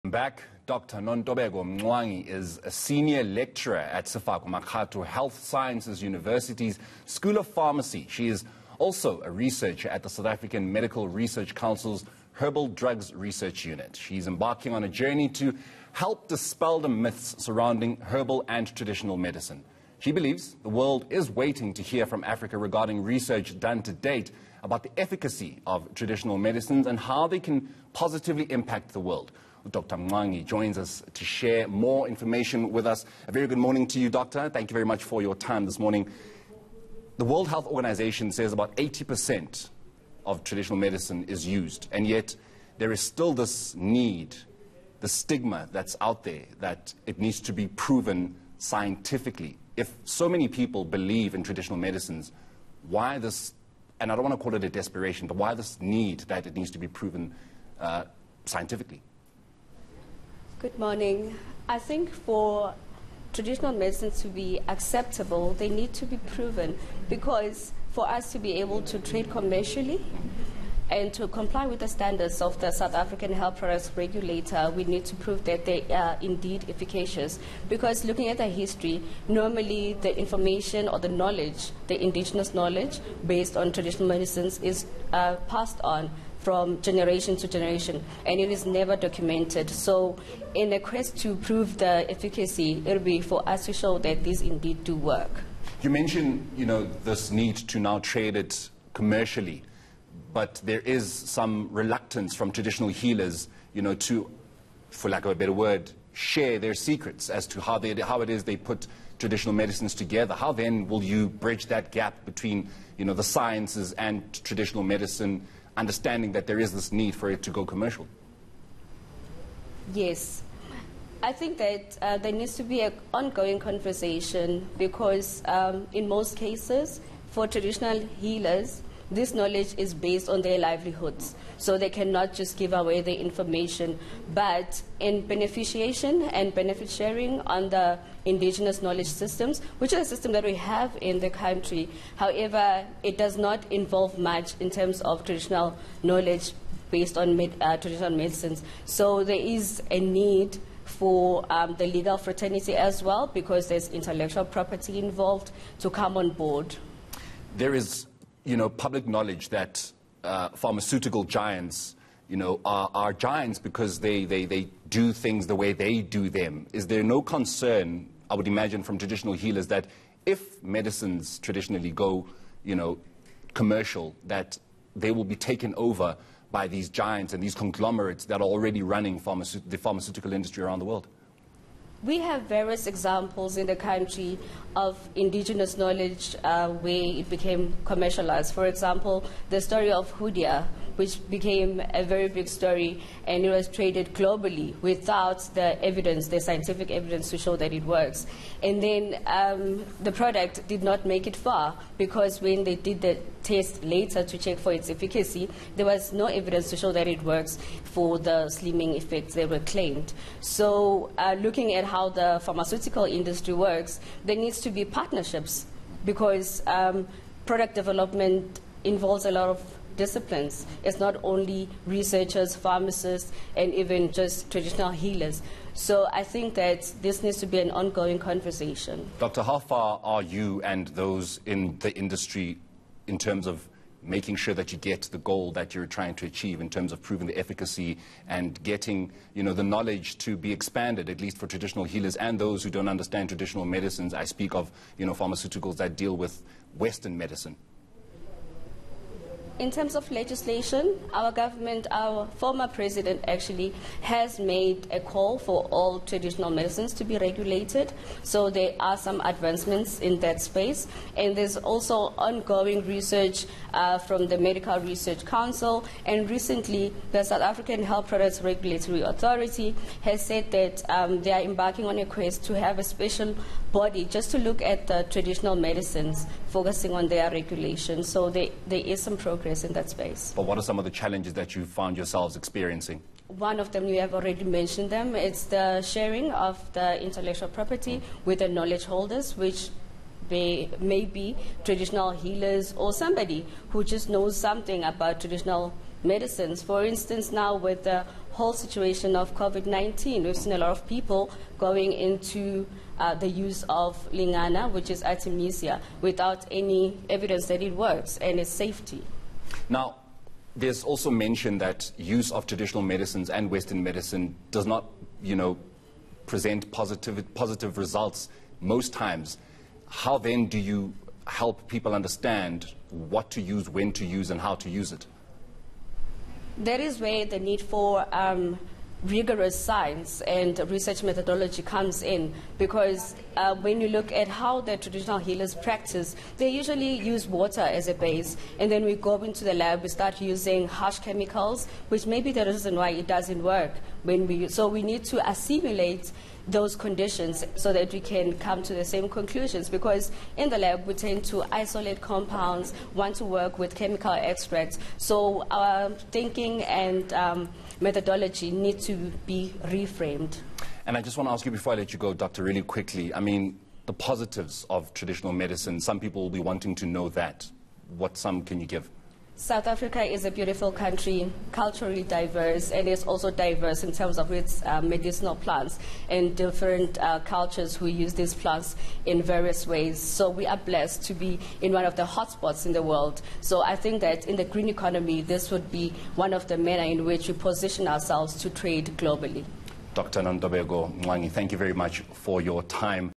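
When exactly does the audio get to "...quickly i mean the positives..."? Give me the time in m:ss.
6:02.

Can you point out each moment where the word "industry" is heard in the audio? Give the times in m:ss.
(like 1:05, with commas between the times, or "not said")
3:00, 3:33, 3:52.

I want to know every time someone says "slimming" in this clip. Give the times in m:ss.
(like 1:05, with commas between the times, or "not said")
3:28.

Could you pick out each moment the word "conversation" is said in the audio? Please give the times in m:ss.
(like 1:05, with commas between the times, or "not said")
2:03, 3:48.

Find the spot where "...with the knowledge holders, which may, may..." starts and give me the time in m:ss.
4:48.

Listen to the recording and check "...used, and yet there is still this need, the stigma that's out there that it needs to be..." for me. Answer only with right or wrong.
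right.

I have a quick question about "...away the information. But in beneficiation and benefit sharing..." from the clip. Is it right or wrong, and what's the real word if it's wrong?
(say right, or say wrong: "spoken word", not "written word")
right.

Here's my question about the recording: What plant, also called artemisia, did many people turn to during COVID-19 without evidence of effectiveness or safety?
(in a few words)
Lengana.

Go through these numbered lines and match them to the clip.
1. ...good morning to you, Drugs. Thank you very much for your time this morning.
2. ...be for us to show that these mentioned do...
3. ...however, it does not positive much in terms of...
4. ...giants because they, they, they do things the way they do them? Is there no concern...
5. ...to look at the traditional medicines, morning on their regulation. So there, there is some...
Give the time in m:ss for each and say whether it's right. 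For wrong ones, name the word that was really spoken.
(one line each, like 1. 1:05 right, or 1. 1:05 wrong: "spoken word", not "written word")
1. 0:33 wrong: "Doctor", not "Drugs"
2. 1:33 wrong: "indeed", not "mentioned"
3. 2:22 wrong: "involve", not "positive"
4. 2:43 right
5. 4:34 wrong: "focusing", not "morning".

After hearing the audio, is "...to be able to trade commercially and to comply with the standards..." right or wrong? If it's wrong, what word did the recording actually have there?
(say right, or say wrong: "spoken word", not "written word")
right.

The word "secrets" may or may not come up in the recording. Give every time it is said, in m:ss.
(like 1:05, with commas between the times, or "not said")
1:46.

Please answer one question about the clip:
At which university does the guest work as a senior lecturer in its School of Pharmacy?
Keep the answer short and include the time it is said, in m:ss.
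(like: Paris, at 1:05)
Sefako Makgatho Health Sciences University, at 0:04.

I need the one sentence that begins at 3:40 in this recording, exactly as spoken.
It's not only researchers, pharmacists, and even just traditional healers.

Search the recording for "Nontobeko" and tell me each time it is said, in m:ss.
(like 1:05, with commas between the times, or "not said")
0:00, 6:30.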